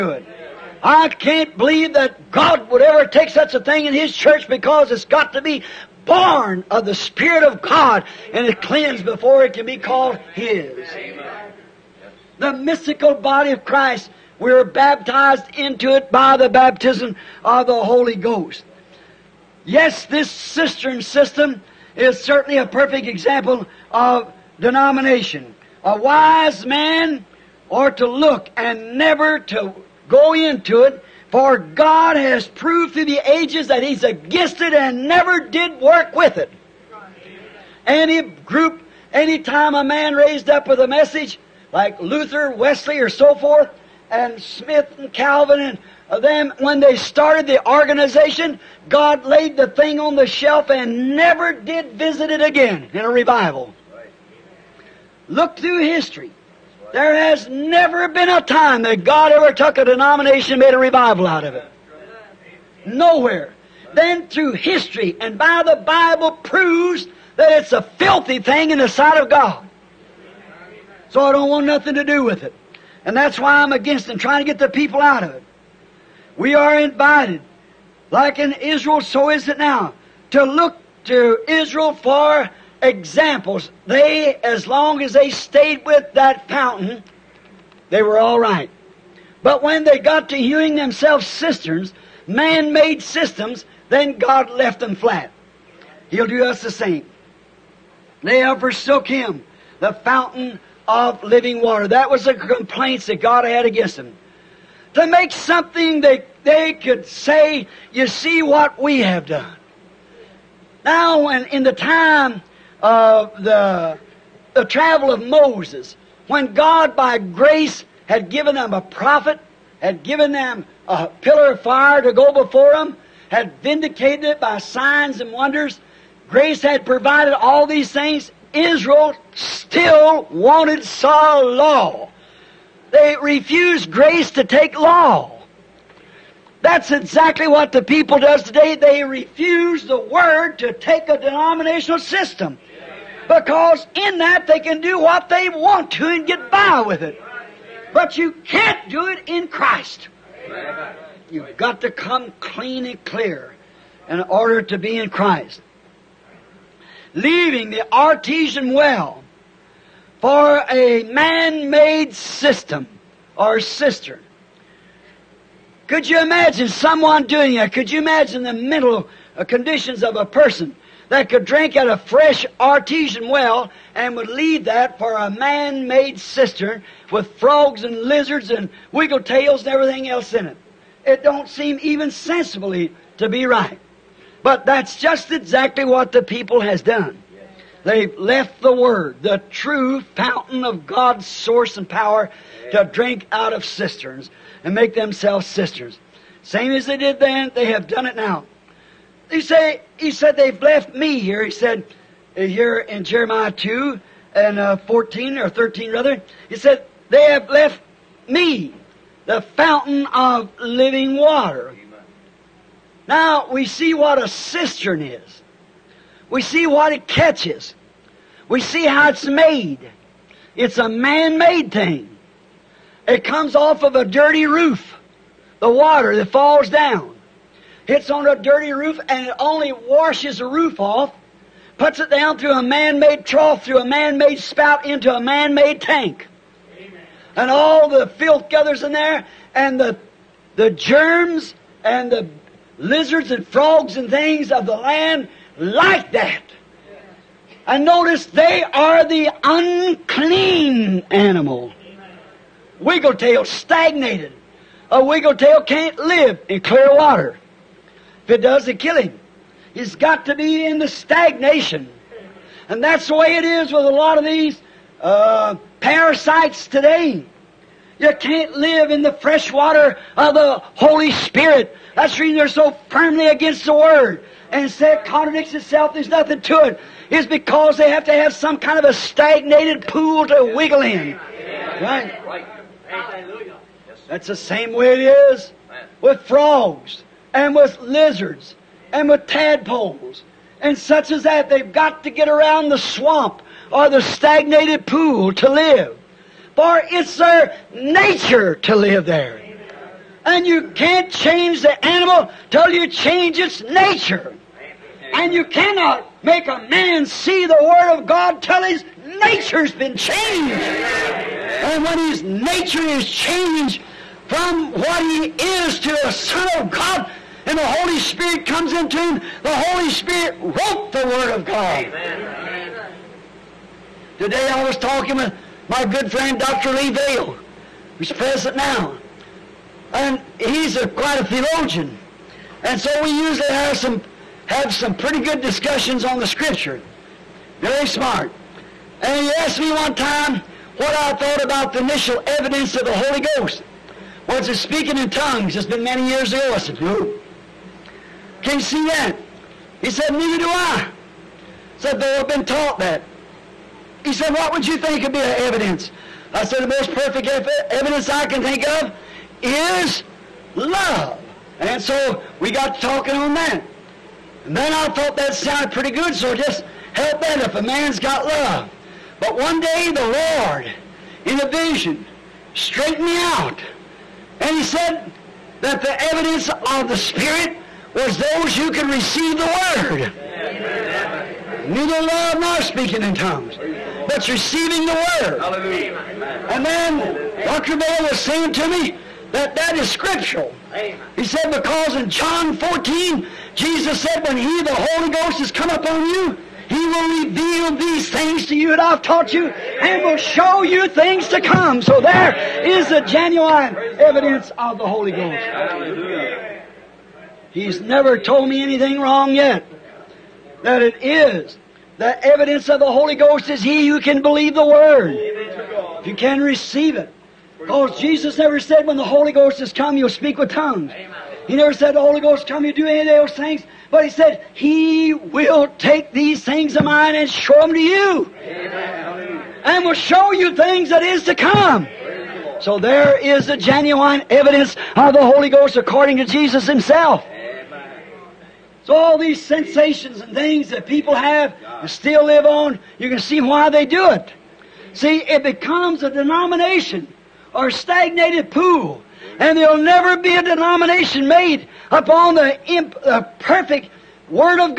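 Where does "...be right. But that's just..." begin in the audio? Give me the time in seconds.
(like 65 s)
183 s.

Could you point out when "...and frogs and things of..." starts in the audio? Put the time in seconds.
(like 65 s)
243 s.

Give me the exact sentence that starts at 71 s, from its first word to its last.
So I don't want nothing to do with it.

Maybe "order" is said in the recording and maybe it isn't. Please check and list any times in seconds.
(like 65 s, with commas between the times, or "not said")
154 s.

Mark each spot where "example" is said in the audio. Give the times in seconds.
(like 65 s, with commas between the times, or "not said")
23 s, 82 s.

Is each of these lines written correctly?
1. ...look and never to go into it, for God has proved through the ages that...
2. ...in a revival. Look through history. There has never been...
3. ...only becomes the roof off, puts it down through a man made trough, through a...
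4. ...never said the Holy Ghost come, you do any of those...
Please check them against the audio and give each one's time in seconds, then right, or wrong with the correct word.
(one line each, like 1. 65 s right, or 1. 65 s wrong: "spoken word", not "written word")
1. 28 s right
2. 52 s right
3. 229 s wrong: "washes", not "becomes"
4. 421 s right.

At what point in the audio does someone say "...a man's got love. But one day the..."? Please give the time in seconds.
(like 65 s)
367 s.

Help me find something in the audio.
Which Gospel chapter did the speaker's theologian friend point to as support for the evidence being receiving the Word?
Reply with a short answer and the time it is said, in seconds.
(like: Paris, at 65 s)
John 14, at 392 s.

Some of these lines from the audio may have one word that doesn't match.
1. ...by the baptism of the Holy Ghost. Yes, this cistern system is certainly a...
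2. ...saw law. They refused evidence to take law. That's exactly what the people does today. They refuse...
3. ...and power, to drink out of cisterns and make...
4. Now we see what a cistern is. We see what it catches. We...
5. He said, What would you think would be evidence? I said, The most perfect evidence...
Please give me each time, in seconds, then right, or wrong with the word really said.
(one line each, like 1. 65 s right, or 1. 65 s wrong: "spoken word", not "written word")
1. 16 s right
2. 130 s wrong: "grace", not "evidence"
3. 191 s right
4. 213 s right
5. 354 s right.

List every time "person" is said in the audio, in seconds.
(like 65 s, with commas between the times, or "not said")
170 s.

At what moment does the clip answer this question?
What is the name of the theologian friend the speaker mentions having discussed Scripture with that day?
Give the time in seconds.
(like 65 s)
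326 s.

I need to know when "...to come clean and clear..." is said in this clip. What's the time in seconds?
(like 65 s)
151 s.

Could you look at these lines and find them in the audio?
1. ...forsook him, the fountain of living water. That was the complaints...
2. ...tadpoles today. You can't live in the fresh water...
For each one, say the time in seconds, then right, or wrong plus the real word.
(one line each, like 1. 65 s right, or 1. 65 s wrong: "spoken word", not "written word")
1. 98 s right
2. 265 s wrong: "parasites", not "tadpoles".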